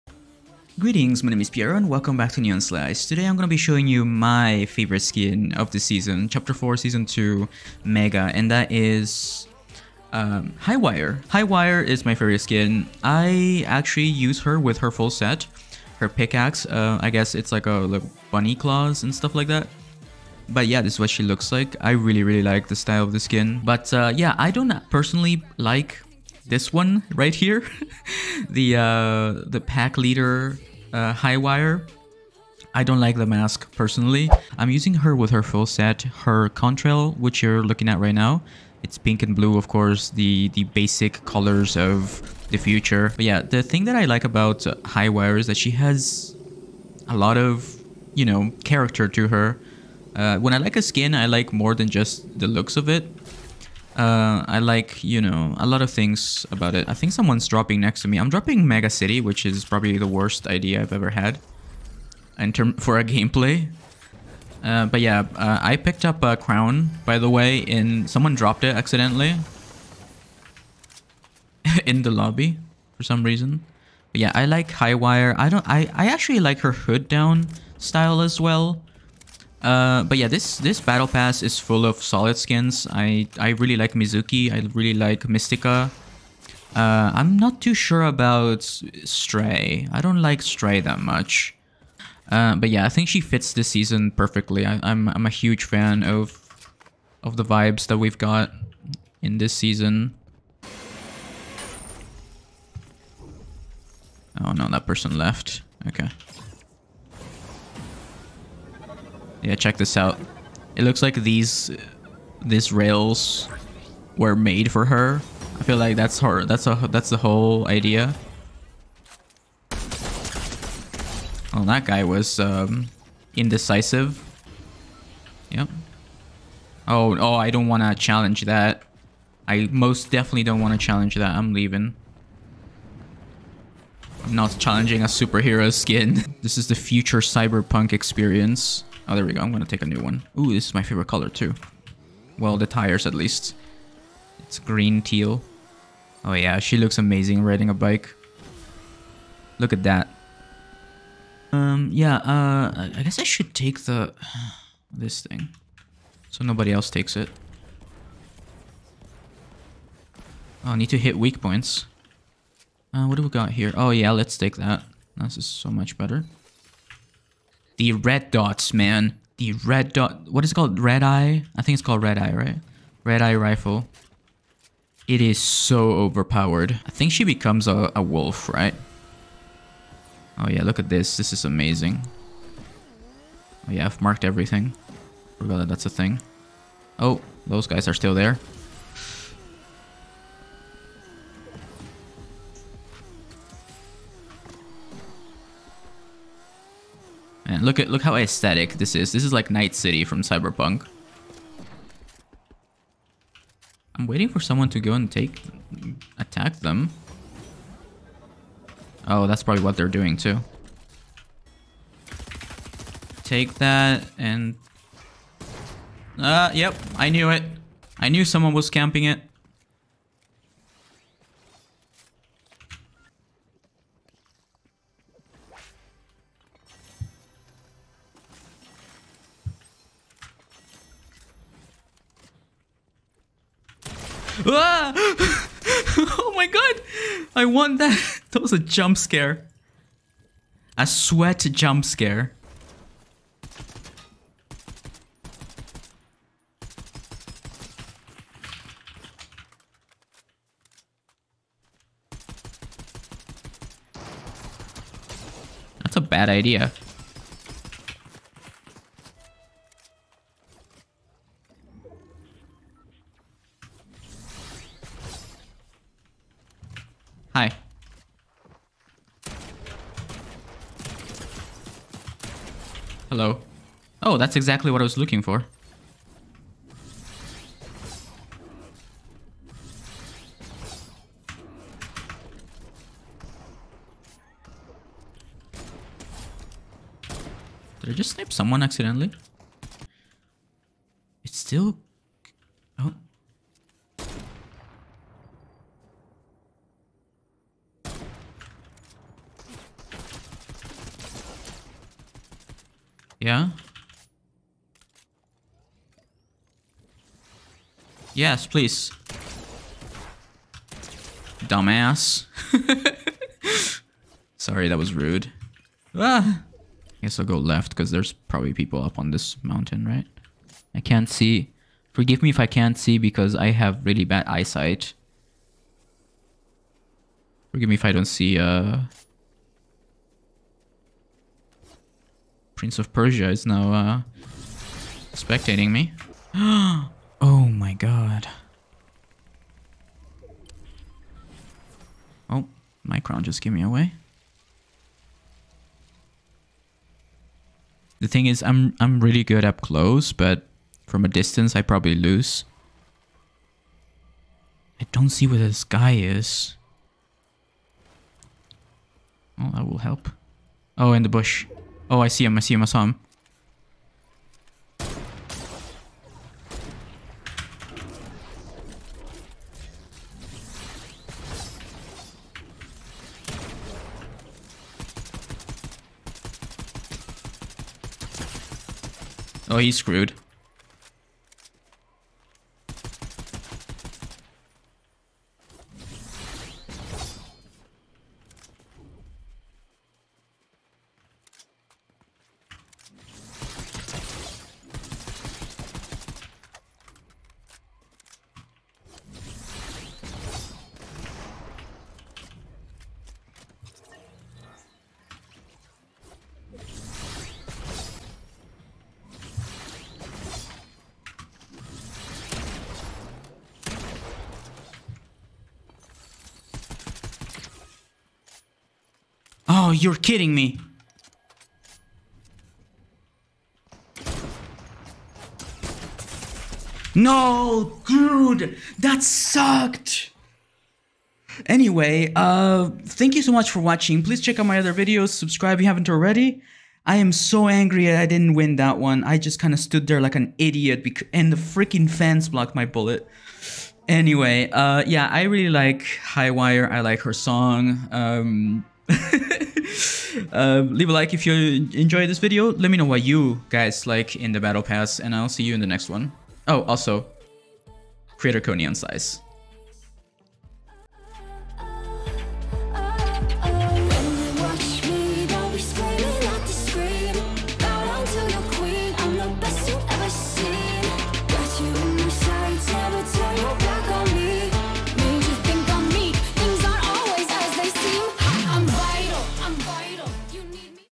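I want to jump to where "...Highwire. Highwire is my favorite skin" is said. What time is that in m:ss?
0:10.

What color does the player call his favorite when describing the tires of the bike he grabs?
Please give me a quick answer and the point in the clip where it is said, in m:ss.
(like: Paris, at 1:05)
green teal, at 2:24.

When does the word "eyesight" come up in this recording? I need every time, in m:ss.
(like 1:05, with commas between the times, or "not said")
5:24.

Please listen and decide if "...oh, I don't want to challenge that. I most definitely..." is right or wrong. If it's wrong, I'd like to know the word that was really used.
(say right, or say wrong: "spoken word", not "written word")
right.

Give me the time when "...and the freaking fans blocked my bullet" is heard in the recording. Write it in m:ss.
7:21.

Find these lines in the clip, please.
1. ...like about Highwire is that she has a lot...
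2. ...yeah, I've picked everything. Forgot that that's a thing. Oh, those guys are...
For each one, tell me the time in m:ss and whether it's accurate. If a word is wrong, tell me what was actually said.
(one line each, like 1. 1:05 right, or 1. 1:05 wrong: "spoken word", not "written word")
1. 0:44 right
2. 3:03 wrong: "marked", not "picked".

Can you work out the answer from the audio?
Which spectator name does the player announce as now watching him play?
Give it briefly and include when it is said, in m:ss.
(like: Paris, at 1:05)
Prince of Persia, at 5:32.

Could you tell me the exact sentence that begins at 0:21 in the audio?
I really, really like the style of the skin.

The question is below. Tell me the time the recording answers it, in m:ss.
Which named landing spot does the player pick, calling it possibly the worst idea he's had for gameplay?
0:58.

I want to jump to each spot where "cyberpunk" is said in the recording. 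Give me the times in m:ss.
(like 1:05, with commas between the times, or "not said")
2:17, 3:20.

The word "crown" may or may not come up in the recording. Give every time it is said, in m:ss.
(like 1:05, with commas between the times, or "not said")
1:06, 5:42.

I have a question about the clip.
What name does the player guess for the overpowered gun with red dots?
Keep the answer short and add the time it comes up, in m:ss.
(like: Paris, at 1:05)
Red eye rifle, at 2:53.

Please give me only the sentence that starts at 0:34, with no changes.
I'm using her with her full set, her contrail, which you're looking at right now.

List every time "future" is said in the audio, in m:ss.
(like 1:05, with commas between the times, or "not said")
0:42, 2:16.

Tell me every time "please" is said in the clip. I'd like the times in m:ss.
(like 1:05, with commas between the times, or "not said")
5:08, 7:14.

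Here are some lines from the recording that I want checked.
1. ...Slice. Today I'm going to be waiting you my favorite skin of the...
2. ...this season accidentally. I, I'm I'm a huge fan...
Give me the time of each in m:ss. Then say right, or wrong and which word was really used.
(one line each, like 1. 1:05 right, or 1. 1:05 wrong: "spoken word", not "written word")
1. 0:02 wrong: "showing", not "waiting"
2. 1:33 wrong: "perfectly", not "accidentally".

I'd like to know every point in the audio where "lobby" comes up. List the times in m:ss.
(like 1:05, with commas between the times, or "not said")
1:12.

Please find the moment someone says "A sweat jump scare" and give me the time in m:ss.
4:00.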